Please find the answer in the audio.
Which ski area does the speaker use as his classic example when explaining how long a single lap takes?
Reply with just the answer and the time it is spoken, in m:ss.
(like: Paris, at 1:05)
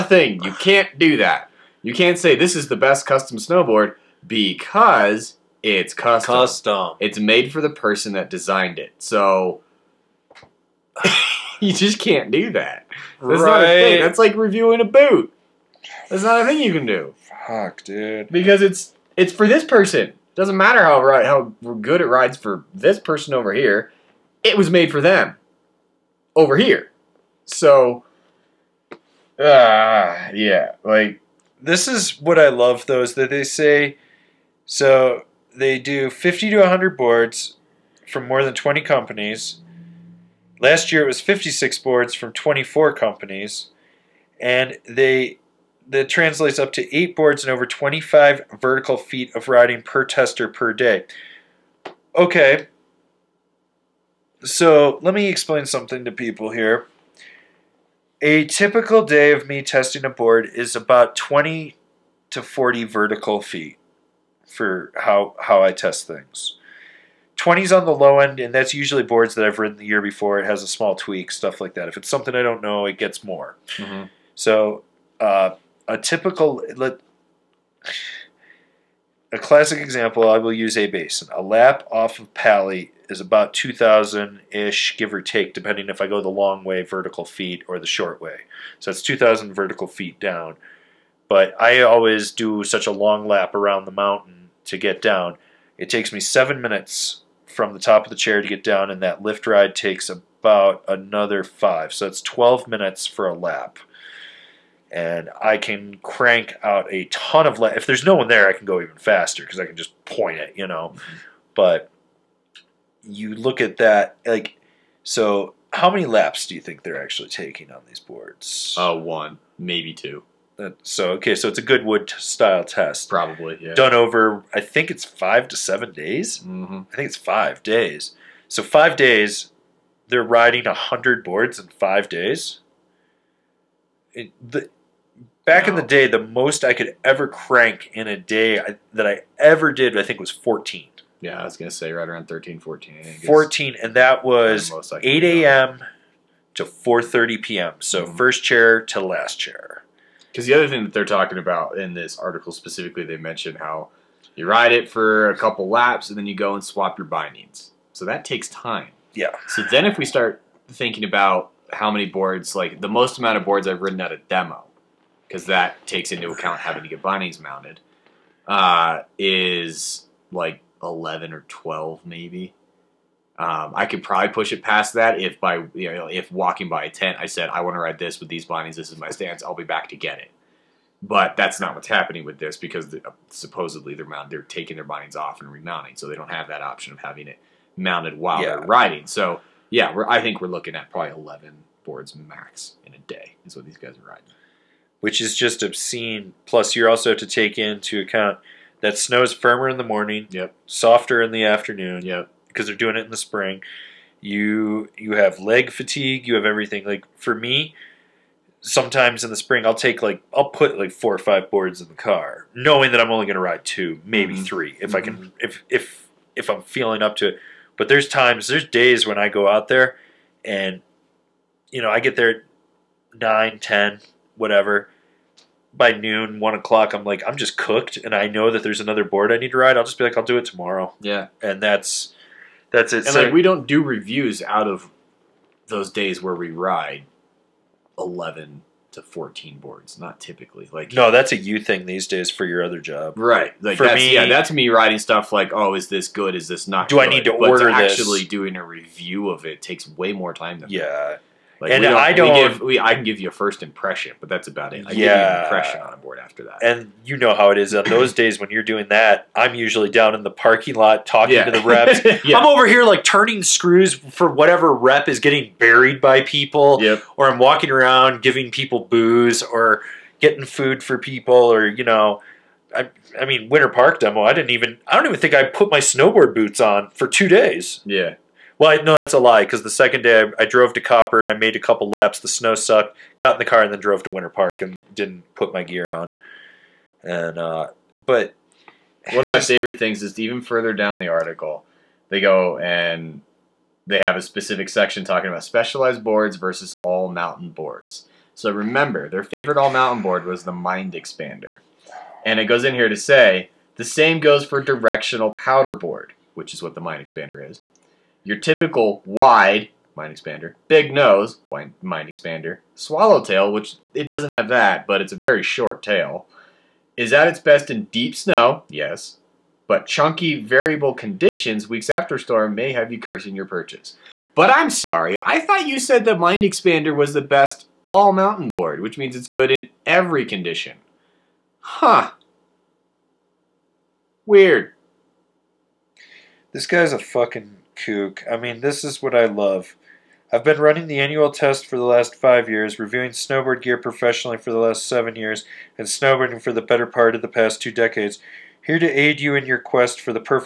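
A-Basin, at 1:20.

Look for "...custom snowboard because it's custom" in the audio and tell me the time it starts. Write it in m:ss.
0:03.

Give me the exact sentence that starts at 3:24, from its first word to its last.
You you have leg fatigue, you have everything.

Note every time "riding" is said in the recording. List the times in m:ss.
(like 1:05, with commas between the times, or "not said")
0:49, 2:10, 3:08, 3:14.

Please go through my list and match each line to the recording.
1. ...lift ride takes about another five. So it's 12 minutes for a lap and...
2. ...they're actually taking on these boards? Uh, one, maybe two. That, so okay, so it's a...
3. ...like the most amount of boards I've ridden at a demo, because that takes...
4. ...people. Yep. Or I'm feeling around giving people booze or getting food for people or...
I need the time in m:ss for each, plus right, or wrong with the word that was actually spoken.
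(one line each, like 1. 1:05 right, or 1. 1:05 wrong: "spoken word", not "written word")
1. 1:39 right
2. 1:56 right
3. 2:42 right
4. 4:26 wrong: "walking", not "feeling".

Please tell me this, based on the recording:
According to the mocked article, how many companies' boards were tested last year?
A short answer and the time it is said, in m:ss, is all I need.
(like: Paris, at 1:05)
24, at 0:42.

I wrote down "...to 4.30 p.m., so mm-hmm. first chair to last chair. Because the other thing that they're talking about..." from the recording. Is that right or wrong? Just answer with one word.
right.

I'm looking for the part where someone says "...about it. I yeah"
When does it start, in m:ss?
4:14.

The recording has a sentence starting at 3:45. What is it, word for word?
By noon, one o'clock, I'm like, I'm just cooked, and I know that there's another board I need to ride.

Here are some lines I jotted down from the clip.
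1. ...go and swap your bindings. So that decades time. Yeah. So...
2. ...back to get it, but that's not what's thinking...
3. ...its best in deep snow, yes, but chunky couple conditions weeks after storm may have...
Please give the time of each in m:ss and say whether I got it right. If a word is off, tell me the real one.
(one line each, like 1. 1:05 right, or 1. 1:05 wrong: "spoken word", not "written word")
1. 2:36 wrong: "takes", not "decades"
2. 2:59 wrong: "happening", not "thinking"
3. 5:17 wrong: "variable", not "couple".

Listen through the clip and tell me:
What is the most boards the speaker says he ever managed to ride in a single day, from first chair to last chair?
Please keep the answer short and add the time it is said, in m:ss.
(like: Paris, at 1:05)
14, at 2:23.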